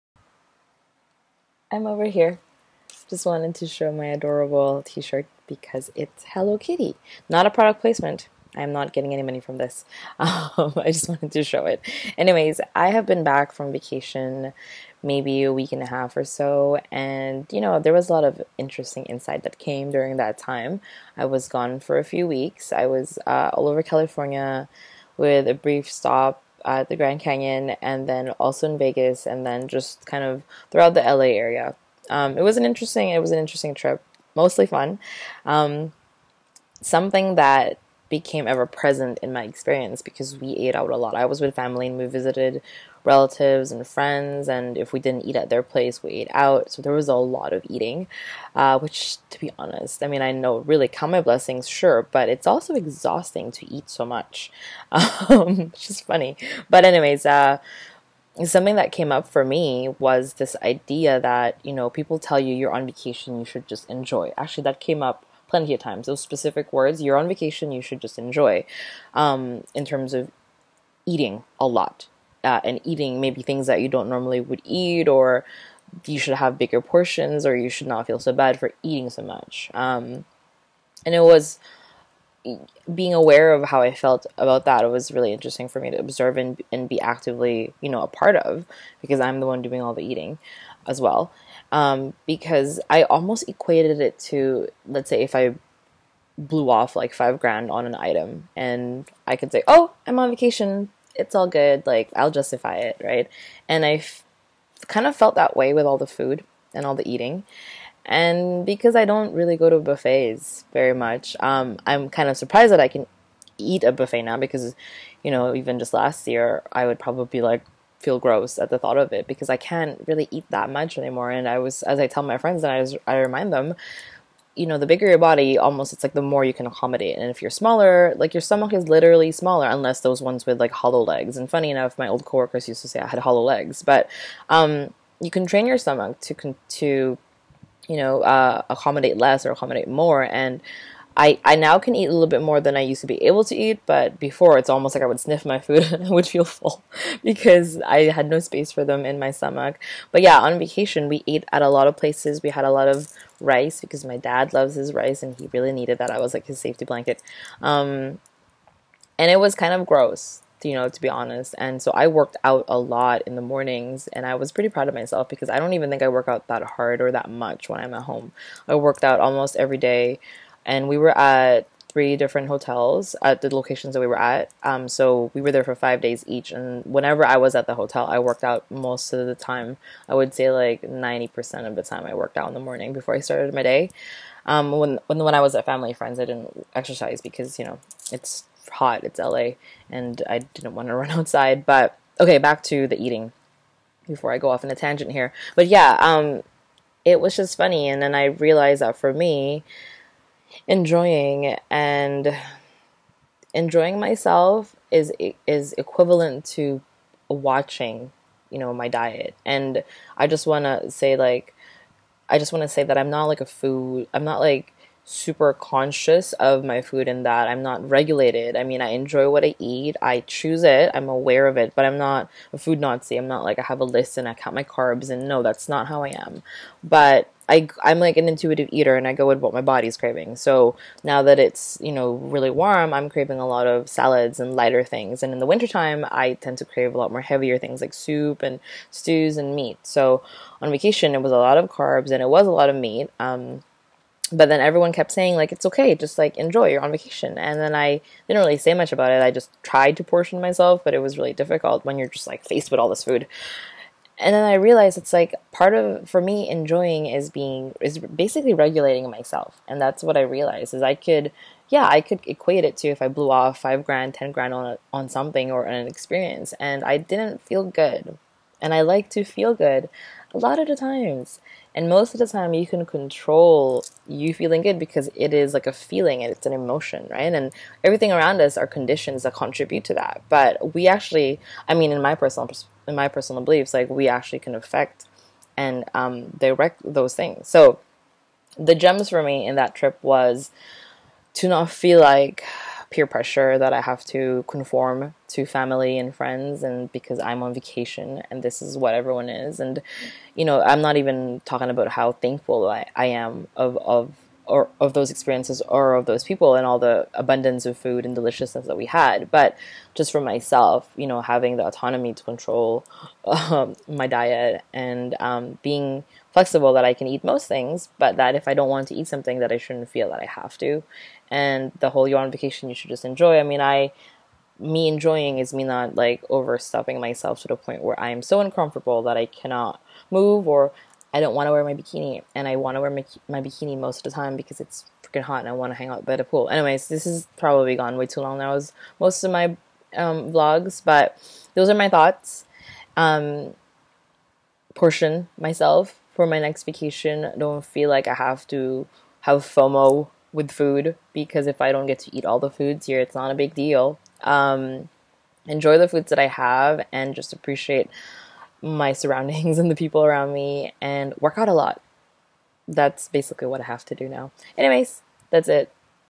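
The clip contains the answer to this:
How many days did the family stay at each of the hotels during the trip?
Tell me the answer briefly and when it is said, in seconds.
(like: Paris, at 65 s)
5, at 175 s.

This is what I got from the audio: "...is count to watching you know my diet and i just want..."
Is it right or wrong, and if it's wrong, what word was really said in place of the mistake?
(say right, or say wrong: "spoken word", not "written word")
wrong: "equivalent", not "count".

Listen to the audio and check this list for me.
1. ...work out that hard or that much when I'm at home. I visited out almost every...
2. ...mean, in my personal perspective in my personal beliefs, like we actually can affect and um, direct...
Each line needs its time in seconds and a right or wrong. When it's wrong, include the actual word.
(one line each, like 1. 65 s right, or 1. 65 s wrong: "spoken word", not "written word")
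1. 166 s wrong: "worked", not "visited"
2. 281 s right.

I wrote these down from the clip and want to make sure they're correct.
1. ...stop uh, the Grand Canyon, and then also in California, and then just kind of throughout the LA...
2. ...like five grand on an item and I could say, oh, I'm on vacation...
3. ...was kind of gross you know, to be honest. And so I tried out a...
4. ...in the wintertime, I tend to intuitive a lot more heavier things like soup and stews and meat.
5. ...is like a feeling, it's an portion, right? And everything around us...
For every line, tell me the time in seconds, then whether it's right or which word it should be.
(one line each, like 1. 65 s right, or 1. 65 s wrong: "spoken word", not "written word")
1. 25 s wrong: "Vegas", not "California"
2. 96 s right
3. 159 s wrong: "worked", not "tried"
4. 235 s wrong: "crave", not "intuitive"
5. 275 s wrong: "emotion", not "portion".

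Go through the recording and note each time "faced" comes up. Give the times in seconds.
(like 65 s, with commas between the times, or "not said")
252 s.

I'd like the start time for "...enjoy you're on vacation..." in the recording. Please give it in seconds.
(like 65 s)
246 s.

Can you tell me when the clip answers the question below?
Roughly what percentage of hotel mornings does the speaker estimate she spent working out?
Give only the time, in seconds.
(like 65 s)
180 s.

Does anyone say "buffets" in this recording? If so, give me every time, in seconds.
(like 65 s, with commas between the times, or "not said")
109 s, 113 s.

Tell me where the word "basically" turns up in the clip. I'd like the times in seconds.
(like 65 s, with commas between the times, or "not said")
257 s, 363 s.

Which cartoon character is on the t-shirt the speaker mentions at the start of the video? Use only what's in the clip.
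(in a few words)
Hello Kitty.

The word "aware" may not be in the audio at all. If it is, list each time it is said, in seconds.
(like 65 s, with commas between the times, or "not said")
83 s, 221 s.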